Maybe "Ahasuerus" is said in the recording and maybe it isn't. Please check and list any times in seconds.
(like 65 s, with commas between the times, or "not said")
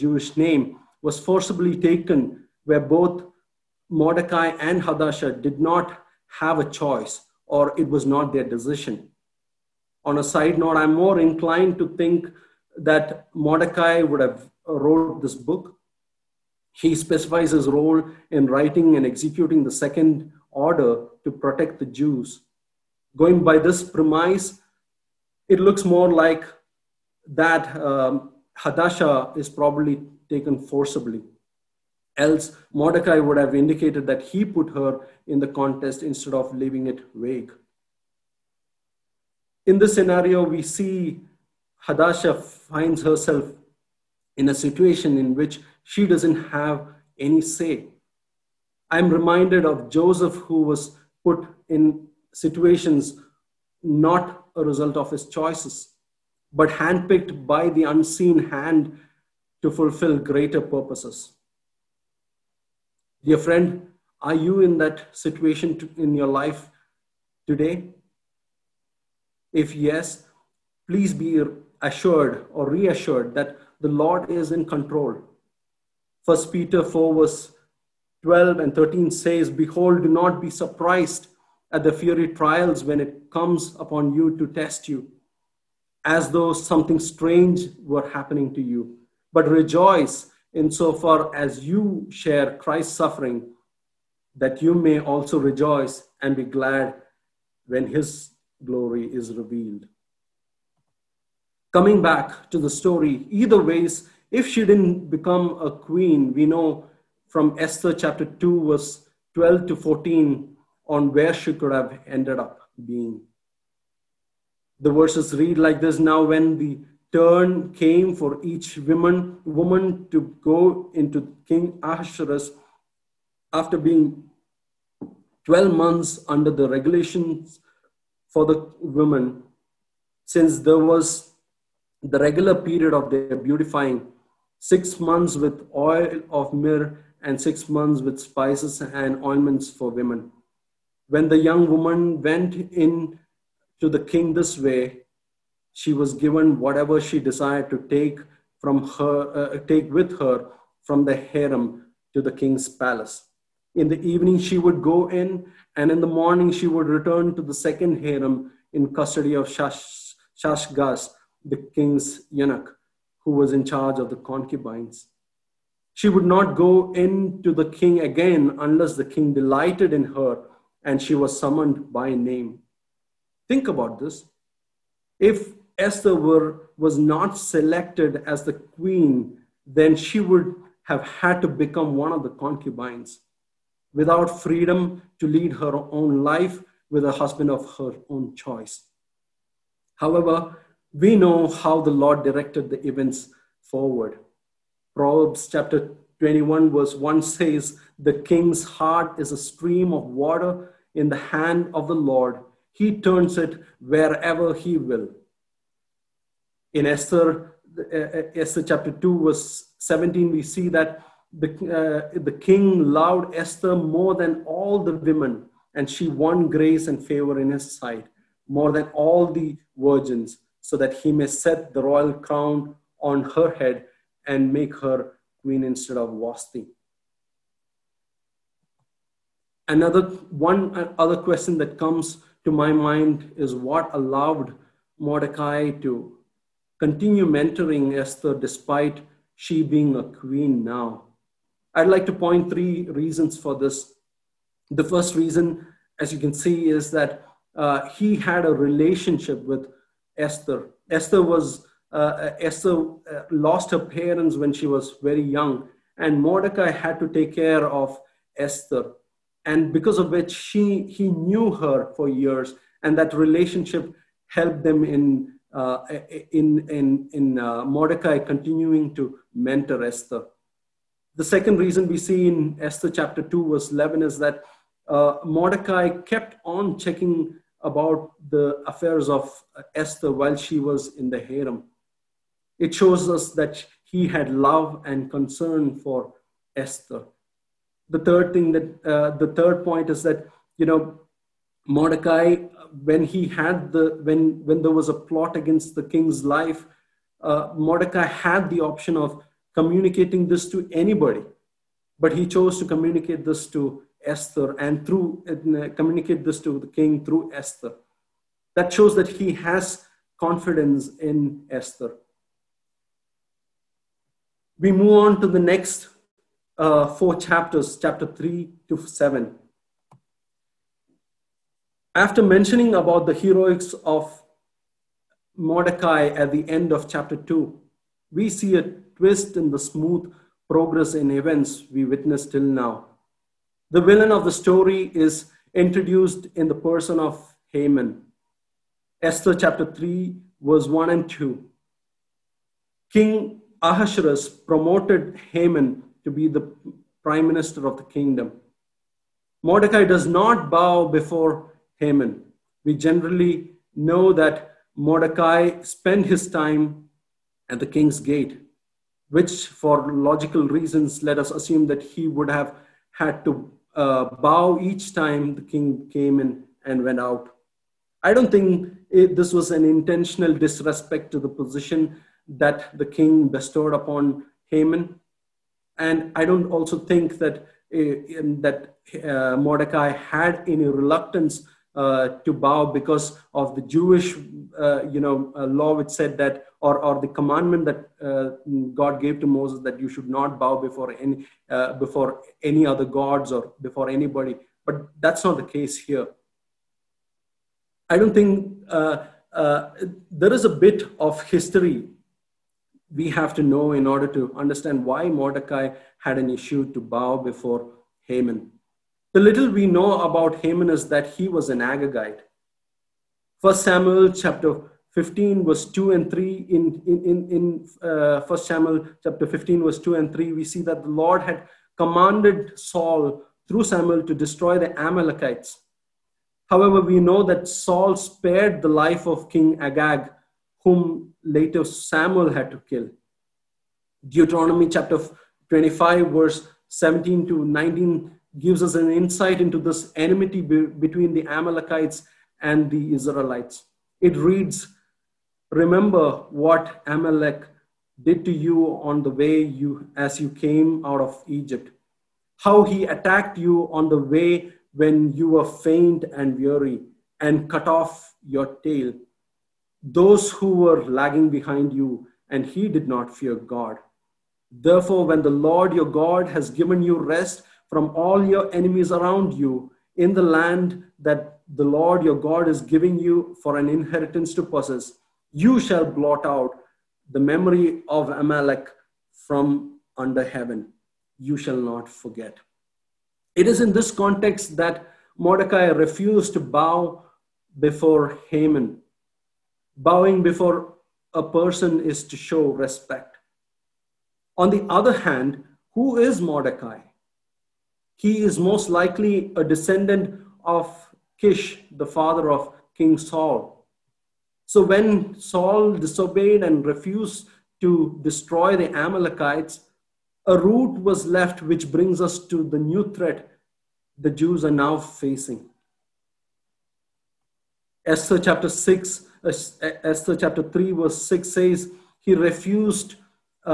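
121 s, 343 s.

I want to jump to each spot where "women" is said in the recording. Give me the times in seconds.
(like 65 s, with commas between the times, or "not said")
128 s, 139 s, 214 s.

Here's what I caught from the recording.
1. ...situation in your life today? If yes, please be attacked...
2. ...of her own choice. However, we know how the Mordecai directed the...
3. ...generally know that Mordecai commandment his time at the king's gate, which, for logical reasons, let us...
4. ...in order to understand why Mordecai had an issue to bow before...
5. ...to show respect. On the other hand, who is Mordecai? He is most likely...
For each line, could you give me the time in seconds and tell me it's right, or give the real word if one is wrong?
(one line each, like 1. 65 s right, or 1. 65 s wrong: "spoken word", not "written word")
1. 65 s wrong: "assured", not "attacked"
2. 187 s wrong: "Lord", not "Mordecai"
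3. 352 s wrong: "spent", not "commandment"
4. 403 s right
5. 492 s right.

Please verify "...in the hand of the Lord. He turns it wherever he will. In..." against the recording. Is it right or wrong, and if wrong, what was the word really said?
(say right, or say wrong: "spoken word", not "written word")
right.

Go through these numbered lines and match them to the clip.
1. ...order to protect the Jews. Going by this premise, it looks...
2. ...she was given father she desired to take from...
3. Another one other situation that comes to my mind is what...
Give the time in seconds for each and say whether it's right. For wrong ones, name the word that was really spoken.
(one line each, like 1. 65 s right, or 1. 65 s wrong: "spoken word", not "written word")
1. 20 s right
2. 145 s wrong: "whatever", not "father"
3. 229 s wrong: "question", not "situation".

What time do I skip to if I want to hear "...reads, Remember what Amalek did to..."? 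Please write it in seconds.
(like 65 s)
444 s.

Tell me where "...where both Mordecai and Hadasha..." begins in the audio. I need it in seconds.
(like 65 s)
2 s.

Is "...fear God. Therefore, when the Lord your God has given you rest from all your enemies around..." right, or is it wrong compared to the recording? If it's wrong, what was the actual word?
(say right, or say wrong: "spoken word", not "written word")
right.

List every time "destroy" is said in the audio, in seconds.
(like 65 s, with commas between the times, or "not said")
424 s, 508 s.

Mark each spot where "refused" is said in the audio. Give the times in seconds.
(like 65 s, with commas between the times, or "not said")
485 s, 506 s, 522 s.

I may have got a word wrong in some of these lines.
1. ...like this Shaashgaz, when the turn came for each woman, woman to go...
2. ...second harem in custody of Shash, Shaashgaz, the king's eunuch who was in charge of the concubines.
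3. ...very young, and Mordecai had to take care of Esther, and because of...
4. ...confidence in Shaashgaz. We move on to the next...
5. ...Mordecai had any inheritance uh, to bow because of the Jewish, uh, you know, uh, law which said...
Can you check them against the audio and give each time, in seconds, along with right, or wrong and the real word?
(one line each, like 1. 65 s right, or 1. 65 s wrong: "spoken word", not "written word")
1. 115 s wrong: "Now", not "Shaashgaz"
2. 157 s right
3. 255 s right
4. 310 s wrong: "Esther", not "Shaashgaz"
5. 379 s wrong: "reluctance", not "inheritance".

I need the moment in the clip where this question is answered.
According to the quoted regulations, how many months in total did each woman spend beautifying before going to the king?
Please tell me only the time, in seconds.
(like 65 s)
125 s.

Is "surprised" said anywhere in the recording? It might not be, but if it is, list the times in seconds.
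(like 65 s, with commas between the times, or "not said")
80 s.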